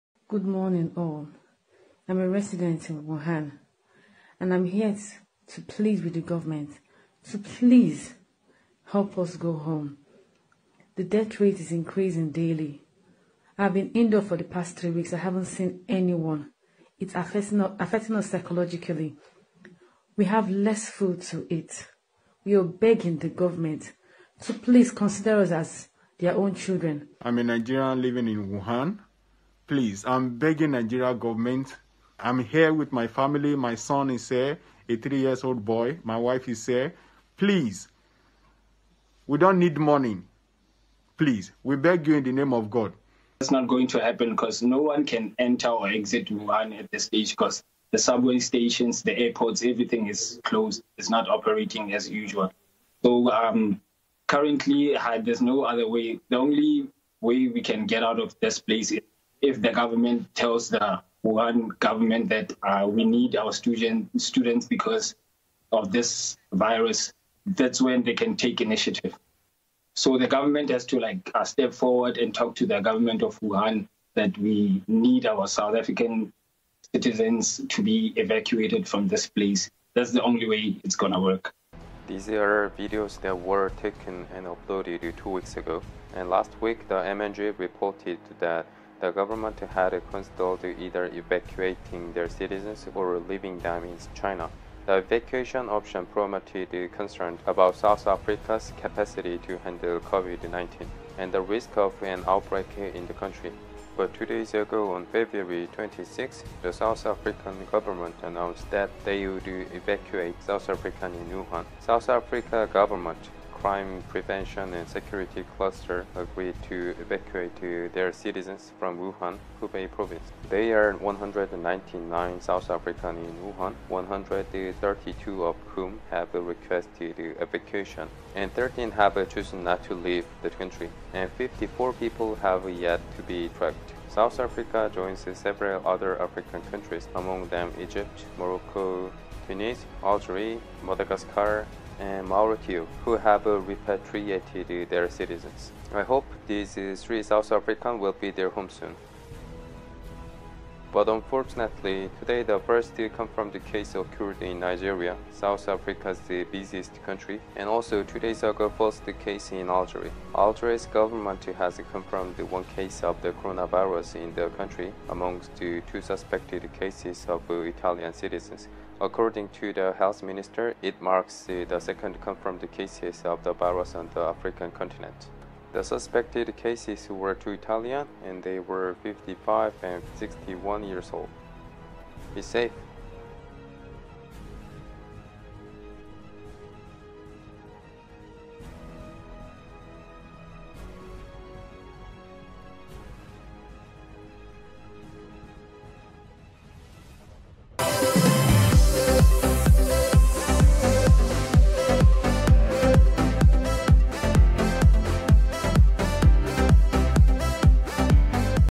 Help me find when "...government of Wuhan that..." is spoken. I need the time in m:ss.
1:12.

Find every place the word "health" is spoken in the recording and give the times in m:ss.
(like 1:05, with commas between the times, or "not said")
2:49.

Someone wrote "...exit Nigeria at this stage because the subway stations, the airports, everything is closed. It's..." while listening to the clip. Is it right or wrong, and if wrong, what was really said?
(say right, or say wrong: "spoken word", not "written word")
wrong: "Wuhan", not "Nigeria".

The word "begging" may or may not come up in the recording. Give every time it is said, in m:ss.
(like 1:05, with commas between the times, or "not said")
0:22, 0:30.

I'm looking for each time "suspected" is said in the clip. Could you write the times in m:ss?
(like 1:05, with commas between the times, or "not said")
2:46, 2:55.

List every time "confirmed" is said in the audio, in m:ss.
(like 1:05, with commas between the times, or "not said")
2:33, 2:41, 2:52.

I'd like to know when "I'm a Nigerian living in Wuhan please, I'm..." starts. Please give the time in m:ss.
0:27.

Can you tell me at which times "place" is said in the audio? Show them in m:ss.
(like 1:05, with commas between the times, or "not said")
0:58, 1:19.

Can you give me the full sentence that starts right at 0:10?
The death rate is increasing daily.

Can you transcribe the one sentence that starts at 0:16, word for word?
It's affecting us, affecting us psychologically.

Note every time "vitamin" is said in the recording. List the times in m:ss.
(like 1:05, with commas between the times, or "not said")
not said.